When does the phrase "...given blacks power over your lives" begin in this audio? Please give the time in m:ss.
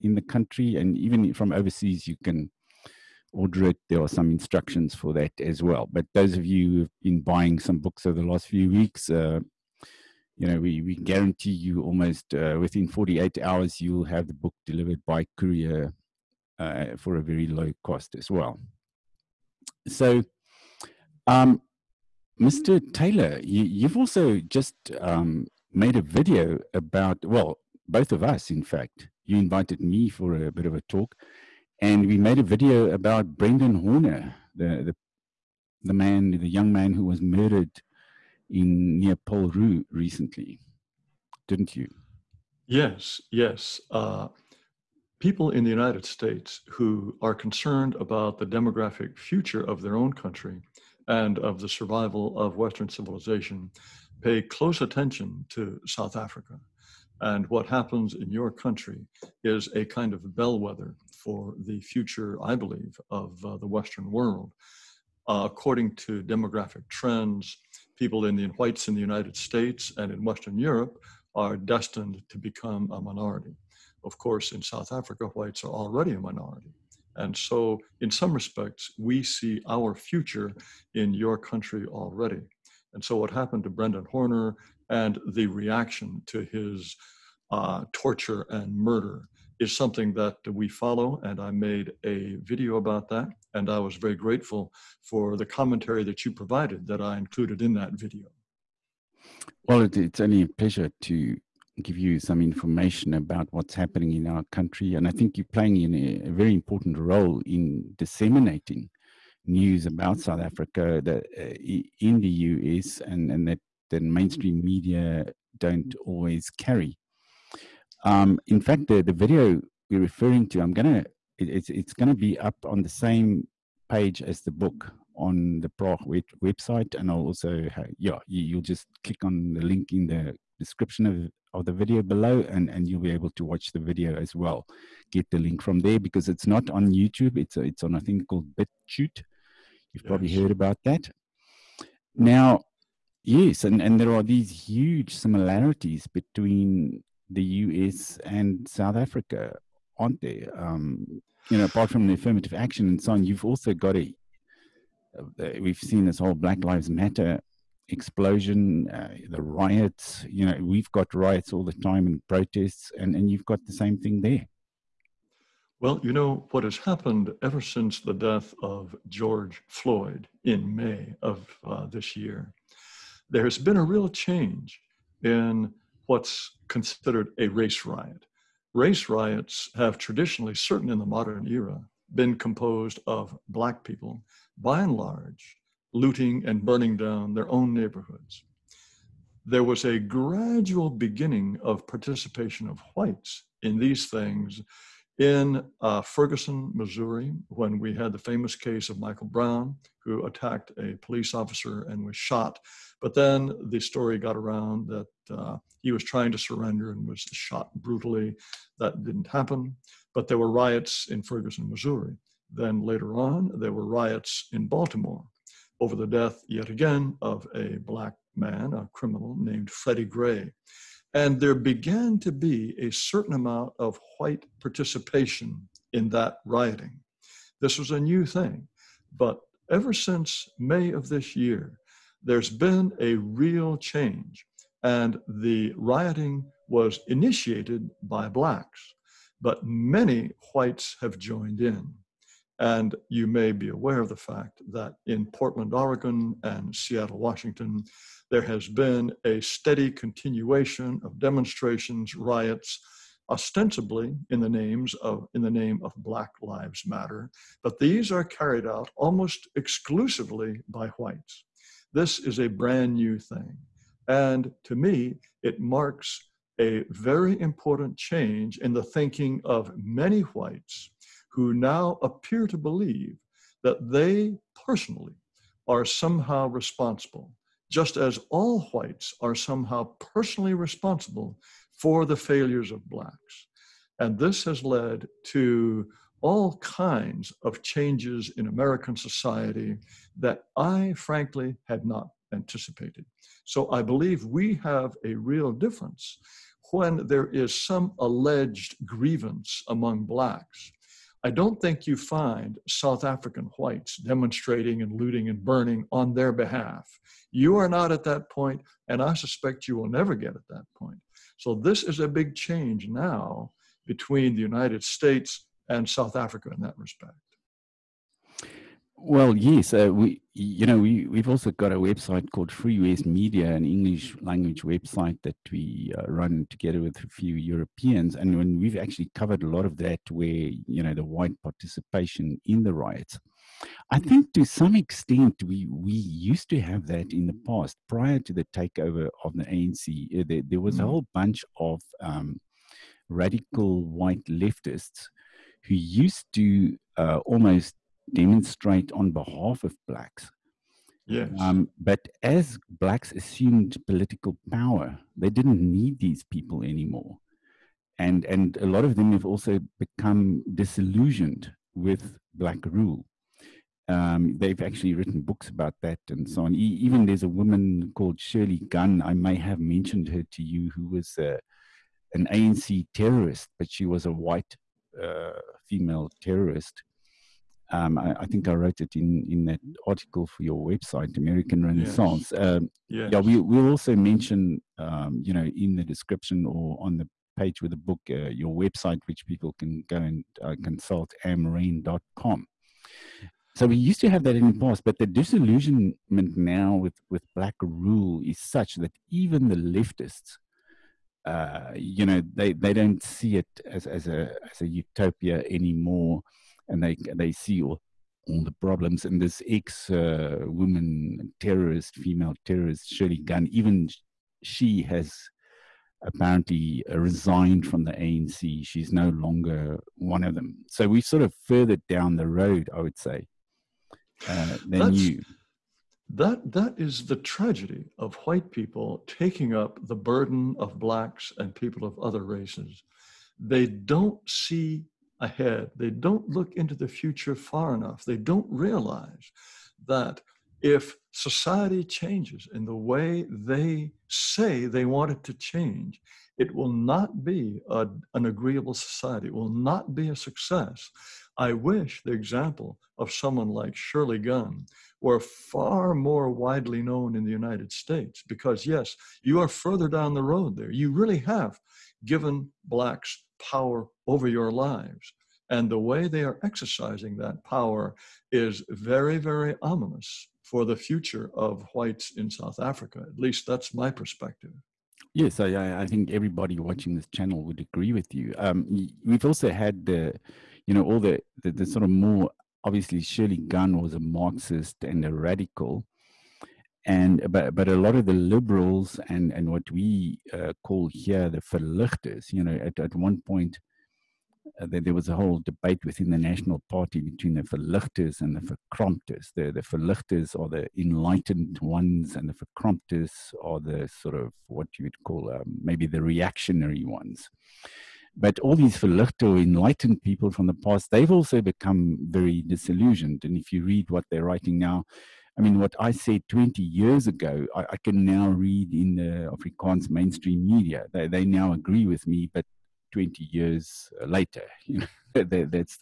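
7:42.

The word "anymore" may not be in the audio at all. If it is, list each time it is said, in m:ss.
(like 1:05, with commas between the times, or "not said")
5:56, 6:45.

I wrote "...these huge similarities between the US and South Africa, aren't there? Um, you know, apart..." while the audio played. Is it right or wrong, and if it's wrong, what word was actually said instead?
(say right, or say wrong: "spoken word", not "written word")
right.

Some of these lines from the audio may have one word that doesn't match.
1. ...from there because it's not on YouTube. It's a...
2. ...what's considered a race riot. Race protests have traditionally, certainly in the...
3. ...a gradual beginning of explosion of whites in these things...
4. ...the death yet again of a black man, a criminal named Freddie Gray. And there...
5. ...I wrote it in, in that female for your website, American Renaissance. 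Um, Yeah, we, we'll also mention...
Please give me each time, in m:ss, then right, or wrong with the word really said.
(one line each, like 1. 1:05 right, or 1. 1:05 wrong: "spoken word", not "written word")
1. 2:15 right
2. 2:56 wrong: "riots", not "protests"
3. 3:09 wrong: "participation", not "explosion"
4. 3:35 right
5. 6:18 wrong: "article", not "female".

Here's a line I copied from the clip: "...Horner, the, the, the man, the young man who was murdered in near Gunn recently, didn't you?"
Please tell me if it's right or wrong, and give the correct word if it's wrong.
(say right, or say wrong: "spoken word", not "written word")
wrong: "Rue", not "Gunn".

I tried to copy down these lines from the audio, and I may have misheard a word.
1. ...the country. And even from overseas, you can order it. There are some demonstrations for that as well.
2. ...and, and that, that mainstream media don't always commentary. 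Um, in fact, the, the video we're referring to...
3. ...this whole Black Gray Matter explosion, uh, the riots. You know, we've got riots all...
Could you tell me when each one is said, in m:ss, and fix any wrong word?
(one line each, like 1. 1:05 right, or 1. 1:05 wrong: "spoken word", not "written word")
1. 0:00 wrong: "instructions", not "demonstrations"
2. 1:53 wrong: "carry", not "commentary"
3. 2:36 wrong: "Lives", not "Gray".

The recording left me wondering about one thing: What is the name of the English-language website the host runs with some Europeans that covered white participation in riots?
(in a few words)
Free West Media.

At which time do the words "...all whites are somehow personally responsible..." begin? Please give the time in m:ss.
4:38.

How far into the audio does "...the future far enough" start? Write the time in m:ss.
7:16.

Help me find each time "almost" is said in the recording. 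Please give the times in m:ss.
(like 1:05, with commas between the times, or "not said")
0:11, 4:18, 5:47.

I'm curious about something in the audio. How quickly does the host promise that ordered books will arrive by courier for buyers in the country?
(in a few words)
48 hours.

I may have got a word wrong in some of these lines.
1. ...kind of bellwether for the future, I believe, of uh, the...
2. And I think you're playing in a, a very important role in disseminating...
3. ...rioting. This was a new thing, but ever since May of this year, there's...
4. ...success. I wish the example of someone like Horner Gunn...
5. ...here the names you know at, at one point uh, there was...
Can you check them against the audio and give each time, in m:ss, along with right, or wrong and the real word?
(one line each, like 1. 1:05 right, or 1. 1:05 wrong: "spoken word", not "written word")
1. 0:59 right
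2. 1:44 right
3. 3:46 right
4. 7:30 wrong: "Shirley", not "Horner"
5. 8:10 wrong: "verligtes", not "names".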